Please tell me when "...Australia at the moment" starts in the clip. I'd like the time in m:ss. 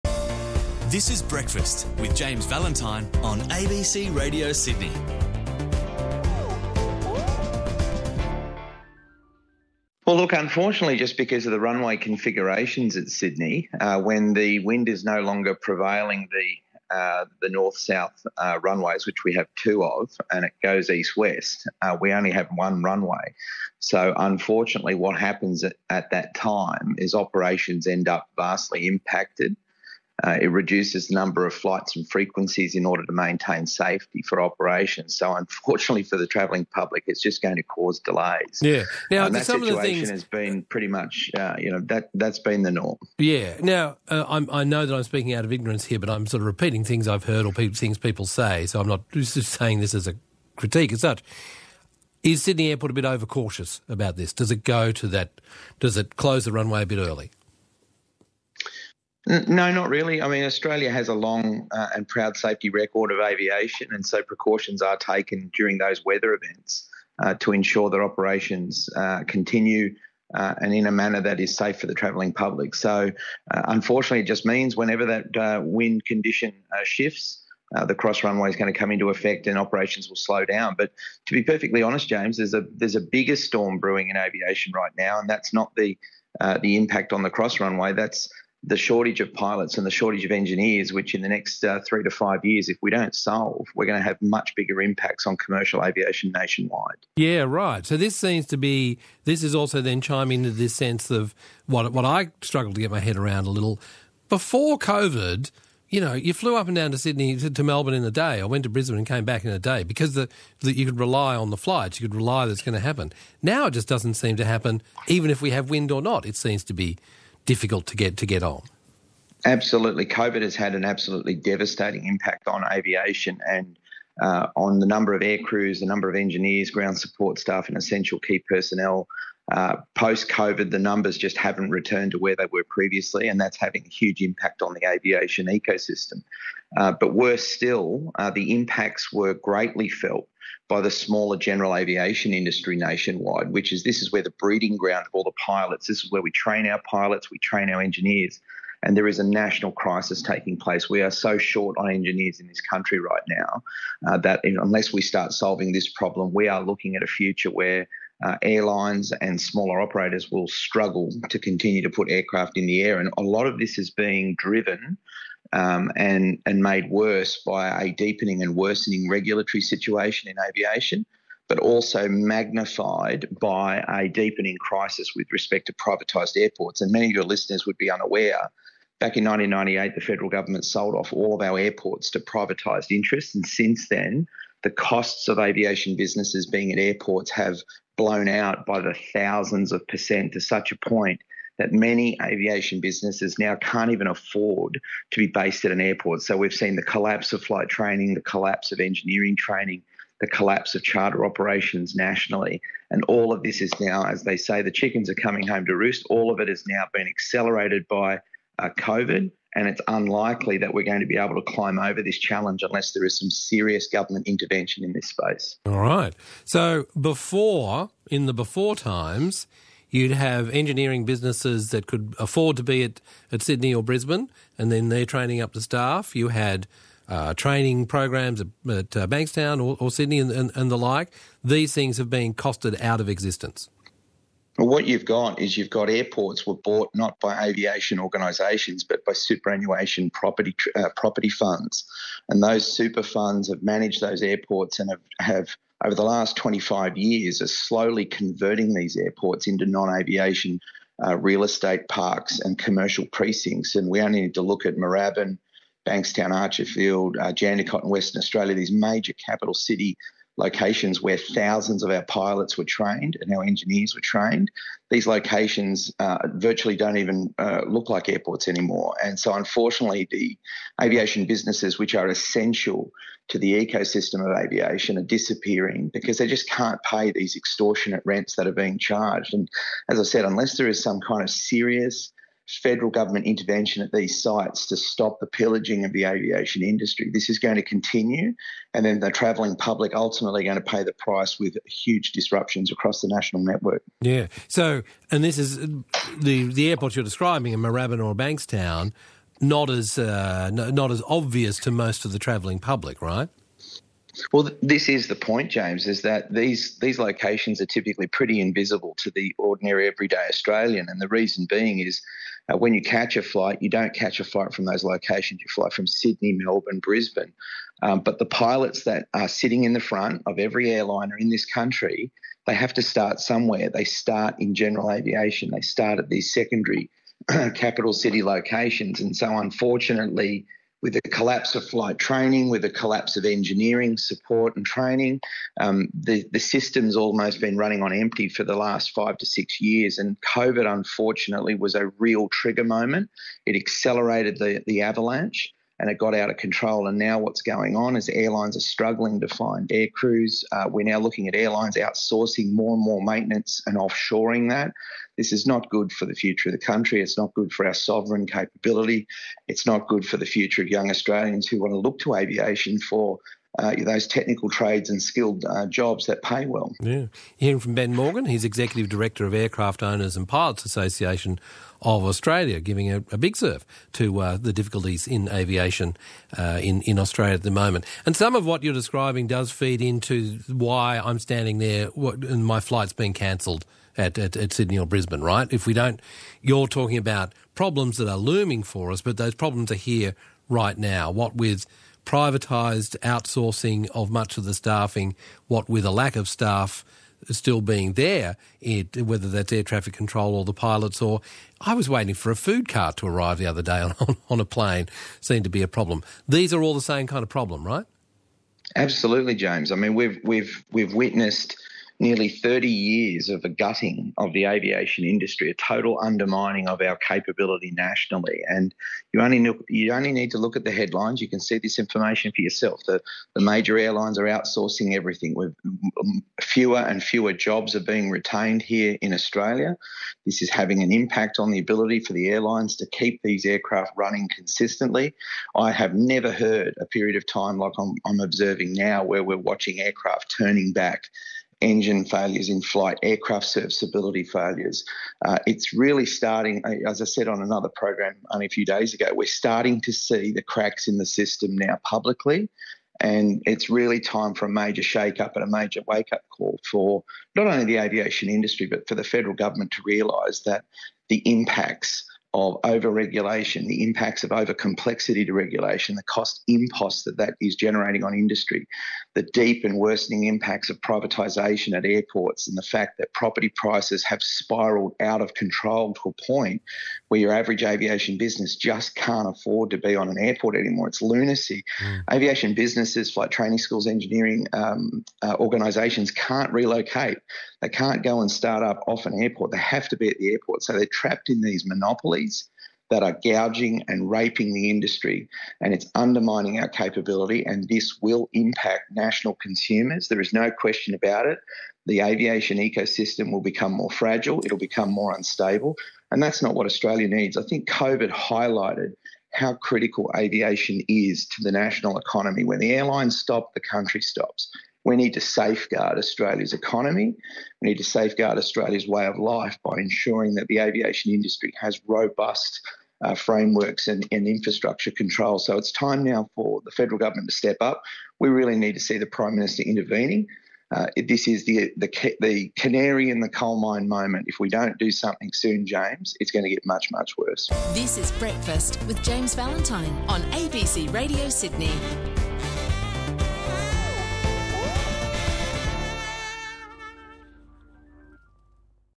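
6:16.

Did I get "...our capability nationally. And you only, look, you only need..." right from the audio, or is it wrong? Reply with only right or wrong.
right.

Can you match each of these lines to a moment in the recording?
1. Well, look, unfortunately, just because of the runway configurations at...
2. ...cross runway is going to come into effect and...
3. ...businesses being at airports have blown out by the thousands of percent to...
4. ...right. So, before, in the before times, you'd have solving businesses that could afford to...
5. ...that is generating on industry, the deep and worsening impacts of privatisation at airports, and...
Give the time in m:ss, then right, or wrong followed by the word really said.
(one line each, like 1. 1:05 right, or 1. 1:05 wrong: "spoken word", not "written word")
1. 0:10 right
2. 1:17 right
3. 3:05 right
4. 3:35 wrong: "engineering", not "solving"
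5. 7:47 right.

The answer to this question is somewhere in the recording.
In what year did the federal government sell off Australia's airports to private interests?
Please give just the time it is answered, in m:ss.
2:59.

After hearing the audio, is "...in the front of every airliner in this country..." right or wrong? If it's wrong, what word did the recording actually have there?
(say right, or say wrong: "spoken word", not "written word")
right.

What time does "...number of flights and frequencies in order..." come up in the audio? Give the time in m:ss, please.
0:31.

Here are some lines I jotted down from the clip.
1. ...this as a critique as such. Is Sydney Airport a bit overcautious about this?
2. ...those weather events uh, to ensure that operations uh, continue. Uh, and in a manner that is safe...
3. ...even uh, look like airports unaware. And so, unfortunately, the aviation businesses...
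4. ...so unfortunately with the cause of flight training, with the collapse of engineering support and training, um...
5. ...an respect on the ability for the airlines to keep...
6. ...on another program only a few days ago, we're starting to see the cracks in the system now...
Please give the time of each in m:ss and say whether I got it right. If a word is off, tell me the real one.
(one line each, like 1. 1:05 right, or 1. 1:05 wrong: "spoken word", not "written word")
1. 0:49 right
2. 1:05 right
3. 4:26 wrong: "anymore", not "unaware"
4. 5:29 wrong: "collapse", not "cause"
5. 7:10 wrong: "impact", not "respect"
6. 7:27 right.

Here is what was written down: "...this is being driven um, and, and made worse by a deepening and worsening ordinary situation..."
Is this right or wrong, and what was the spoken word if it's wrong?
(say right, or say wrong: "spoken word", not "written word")
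wrong: "regulatory", not "ordinary".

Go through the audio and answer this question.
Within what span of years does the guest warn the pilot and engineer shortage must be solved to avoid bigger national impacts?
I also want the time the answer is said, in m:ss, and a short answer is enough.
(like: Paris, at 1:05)
3 to 5 years, at 1:31.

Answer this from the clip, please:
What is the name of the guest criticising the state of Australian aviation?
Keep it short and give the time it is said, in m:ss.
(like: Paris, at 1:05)
Ben Morgan, at 6:07.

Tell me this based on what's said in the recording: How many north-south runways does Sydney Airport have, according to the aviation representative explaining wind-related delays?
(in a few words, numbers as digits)
2.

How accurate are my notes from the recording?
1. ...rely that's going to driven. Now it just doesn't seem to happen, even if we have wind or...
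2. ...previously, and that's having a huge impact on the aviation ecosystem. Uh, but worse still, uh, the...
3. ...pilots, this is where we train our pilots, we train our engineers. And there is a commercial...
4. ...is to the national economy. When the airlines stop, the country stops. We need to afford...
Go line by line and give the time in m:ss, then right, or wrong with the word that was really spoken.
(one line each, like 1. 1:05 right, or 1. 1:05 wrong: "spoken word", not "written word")
1. 1:52 wrong: "happen", not "driven"
2. 2:12 right
3. 2:25 wrong: "national", not "commercial"
4. 8:30 wrong: "safeguard", not "afford".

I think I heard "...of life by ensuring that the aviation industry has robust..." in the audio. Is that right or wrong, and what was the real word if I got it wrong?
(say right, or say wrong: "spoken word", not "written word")
right.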